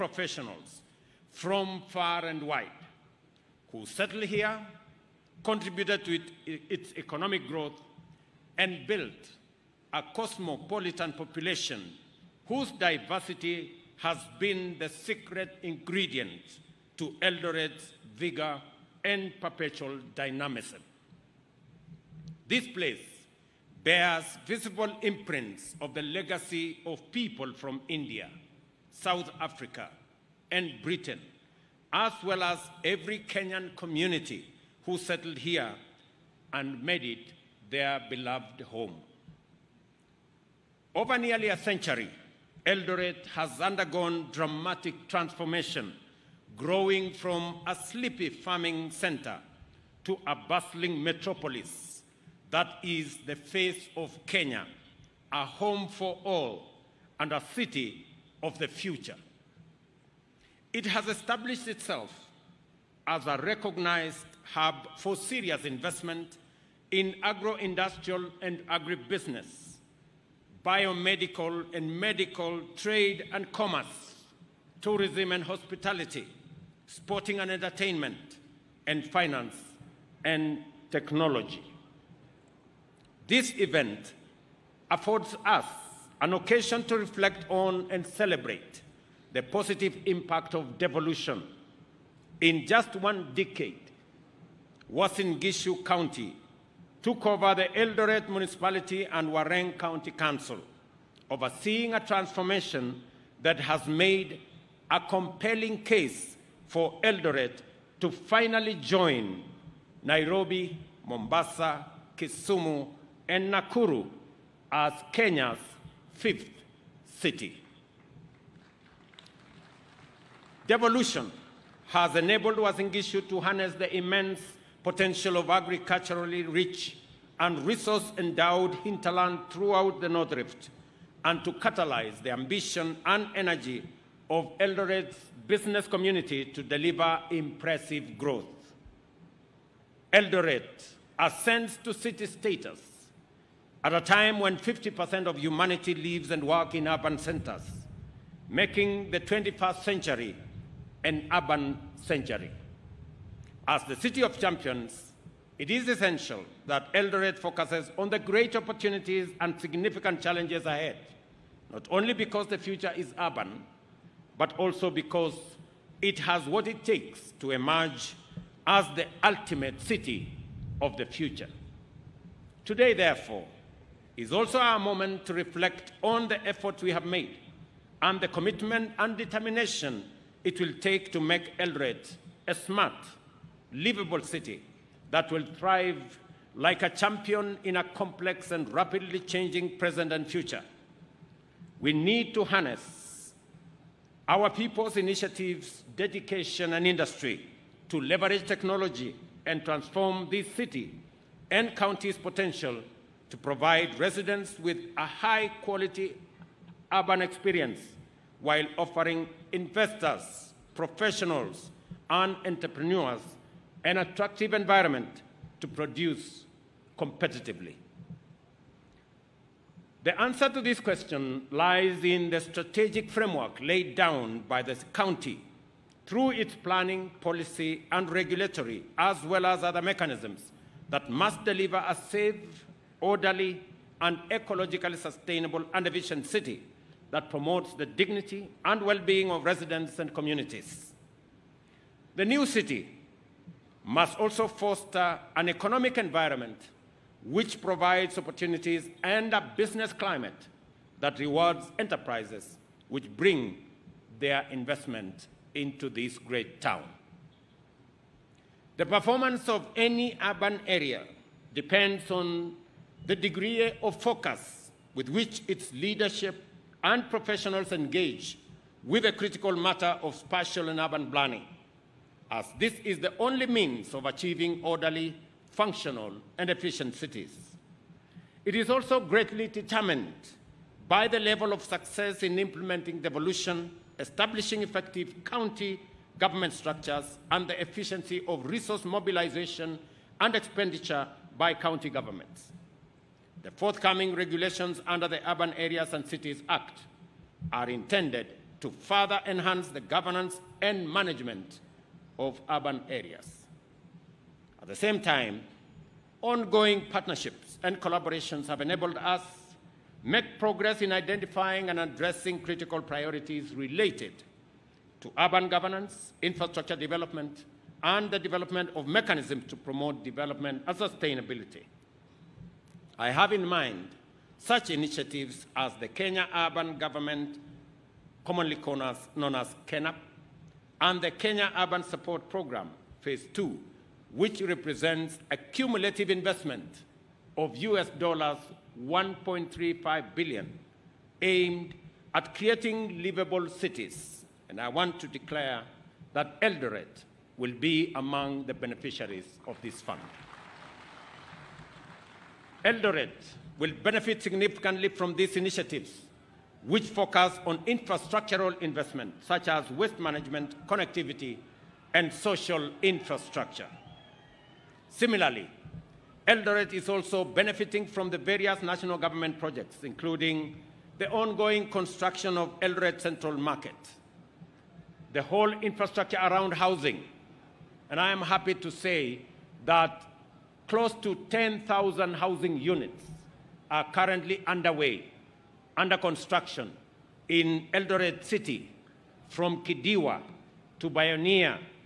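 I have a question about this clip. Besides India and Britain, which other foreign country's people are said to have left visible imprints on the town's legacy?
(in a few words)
South Africa.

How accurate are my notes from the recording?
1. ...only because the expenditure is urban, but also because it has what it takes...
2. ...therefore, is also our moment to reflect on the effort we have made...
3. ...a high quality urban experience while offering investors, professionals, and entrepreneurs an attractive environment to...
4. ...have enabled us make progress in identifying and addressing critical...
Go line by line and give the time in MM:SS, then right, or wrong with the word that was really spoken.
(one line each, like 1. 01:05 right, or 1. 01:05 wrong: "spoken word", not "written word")
1. 02:41 wrong: "future", not "expenditure"
2. 02:52 right
3. 03:24 right
4. 05:08 right.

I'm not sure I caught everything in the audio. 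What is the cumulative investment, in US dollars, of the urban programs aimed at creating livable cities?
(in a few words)
US$1.35 billion.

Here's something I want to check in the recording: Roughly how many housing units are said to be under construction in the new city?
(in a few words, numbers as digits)
10,000.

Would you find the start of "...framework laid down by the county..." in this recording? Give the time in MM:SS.
03:43.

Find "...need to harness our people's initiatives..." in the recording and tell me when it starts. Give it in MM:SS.
03:11.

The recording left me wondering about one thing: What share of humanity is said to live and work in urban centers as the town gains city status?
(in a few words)
50%.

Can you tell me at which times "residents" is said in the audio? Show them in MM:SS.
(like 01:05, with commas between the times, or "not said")
03:23, 03:59.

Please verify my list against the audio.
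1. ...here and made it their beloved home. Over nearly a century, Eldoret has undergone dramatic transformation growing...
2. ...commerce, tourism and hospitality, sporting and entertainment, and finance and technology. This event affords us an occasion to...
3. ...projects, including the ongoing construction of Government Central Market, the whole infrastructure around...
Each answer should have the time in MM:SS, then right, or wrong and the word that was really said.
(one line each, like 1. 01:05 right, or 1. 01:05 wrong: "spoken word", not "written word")
1. 00:35 right
2. 01:13 right
3. 06:09 wrong: "Eldoret", not "Government".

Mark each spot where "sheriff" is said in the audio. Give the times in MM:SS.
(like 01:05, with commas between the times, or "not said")
not said.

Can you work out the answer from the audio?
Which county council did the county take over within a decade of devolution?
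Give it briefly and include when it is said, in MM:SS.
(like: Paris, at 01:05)
Wareng County Council, at 01:39.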